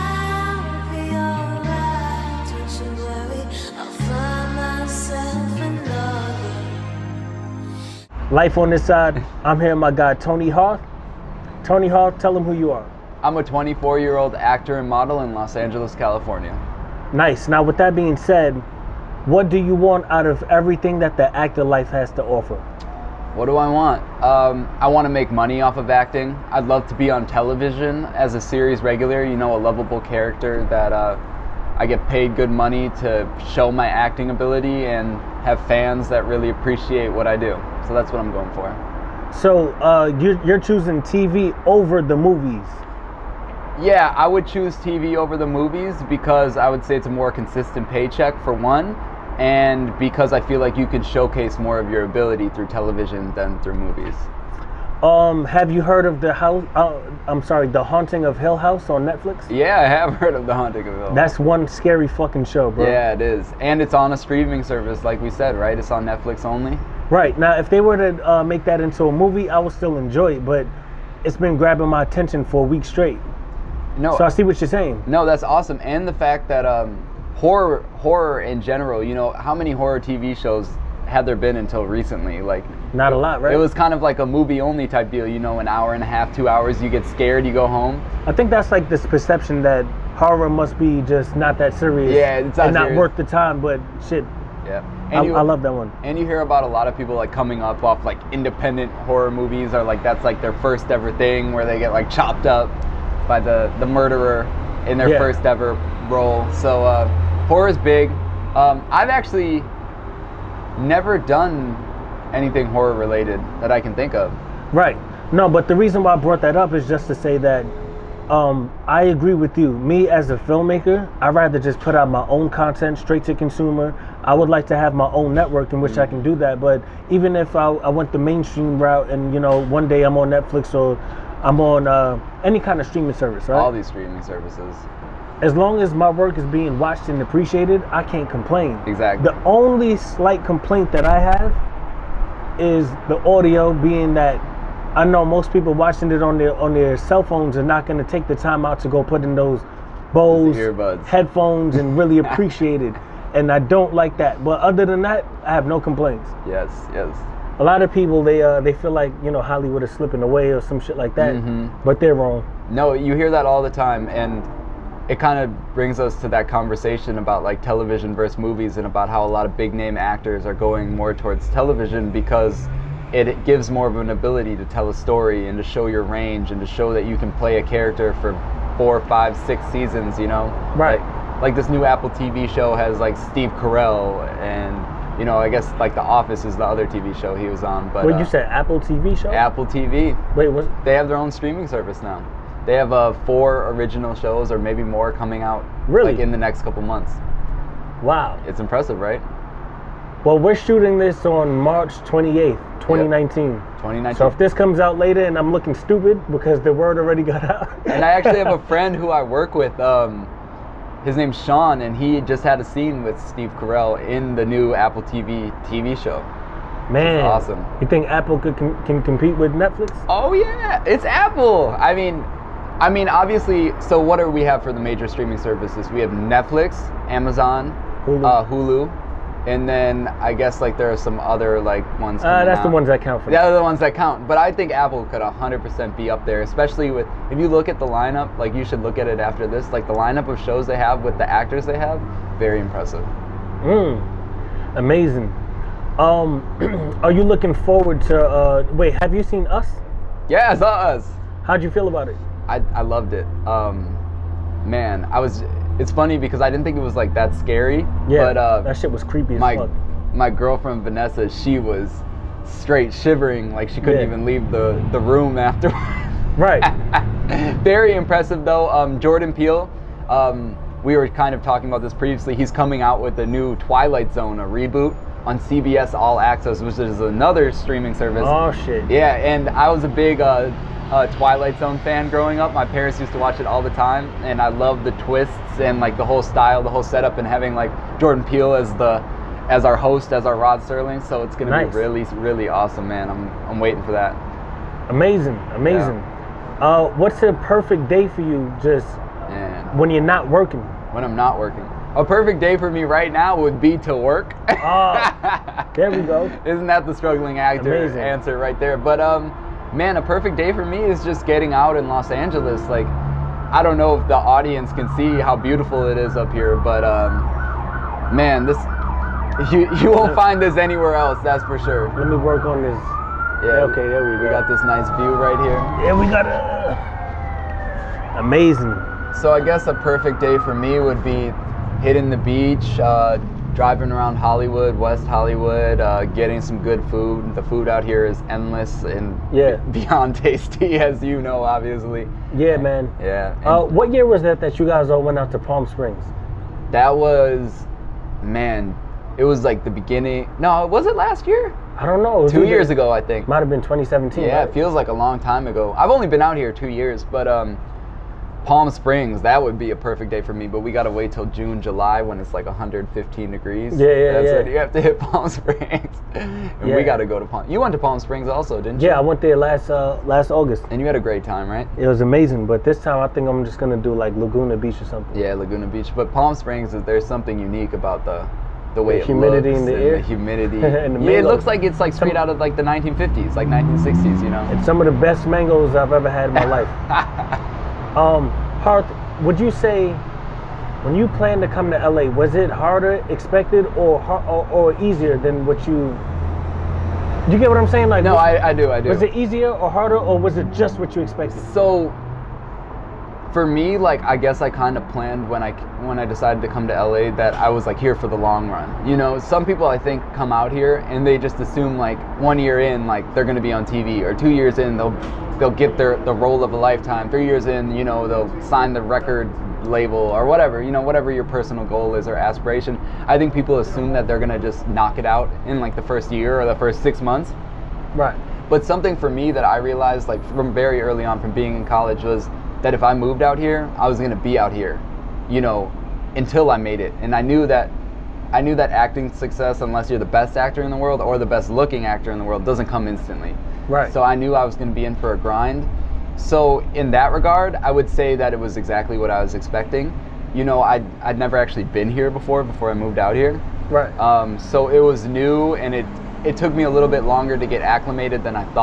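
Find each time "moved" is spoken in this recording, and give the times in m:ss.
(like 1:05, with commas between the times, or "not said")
7:12, 7:32.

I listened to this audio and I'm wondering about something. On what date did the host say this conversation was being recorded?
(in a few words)
March 28th, 2019.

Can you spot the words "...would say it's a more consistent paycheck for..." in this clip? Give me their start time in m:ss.
0:46.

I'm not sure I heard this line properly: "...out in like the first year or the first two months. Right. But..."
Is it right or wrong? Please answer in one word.
wrong.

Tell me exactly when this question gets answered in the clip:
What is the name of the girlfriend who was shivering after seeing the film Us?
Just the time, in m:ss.
4:20.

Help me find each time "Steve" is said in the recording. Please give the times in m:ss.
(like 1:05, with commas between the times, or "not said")
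3:03, 3:33.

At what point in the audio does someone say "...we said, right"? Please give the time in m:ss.
1:05.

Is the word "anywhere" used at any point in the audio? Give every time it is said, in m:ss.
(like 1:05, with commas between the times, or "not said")
5:20.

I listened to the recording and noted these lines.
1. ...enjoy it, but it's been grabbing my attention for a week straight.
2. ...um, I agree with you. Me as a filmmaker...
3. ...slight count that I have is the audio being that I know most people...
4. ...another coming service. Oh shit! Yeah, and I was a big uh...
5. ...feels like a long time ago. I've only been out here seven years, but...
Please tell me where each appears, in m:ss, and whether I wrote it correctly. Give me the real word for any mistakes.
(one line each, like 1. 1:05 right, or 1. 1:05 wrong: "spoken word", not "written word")
1. 1:09 right
2. 1:58 right
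3. 2:19 wrong: "complaint", not "count"
4. 4:37 wrong: "streaming", not "coming"
5. 5:54 wrong: "two", not "seven".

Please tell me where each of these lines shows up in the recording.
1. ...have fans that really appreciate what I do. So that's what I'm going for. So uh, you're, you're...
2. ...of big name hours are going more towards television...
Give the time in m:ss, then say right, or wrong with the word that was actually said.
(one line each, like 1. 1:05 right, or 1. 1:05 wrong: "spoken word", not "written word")
1. 0:35 right
2. 2:49 wrong: "actors", not "hours".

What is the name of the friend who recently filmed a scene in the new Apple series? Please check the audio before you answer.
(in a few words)
Sean.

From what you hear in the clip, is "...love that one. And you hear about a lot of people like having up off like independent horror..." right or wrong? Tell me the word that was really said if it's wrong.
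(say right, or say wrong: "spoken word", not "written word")
wrong: "coming", not "having".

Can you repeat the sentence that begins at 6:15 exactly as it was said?
Yeah, Laguna Beach, but Palm Springs is there's something unique about the the way the humidity in the air, the humidity.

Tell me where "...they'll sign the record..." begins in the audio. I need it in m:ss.
6:58.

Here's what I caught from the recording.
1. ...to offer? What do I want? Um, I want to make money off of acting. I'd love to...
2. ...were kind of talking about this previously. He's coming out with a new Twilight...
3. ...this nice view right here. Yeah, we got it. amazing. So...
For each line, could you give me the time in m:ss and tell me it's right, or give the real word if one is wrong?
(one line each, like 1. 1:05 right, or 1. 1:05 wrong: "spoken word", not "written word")
1. 0:22 right
2. 4:30 right
3. 5:24 right.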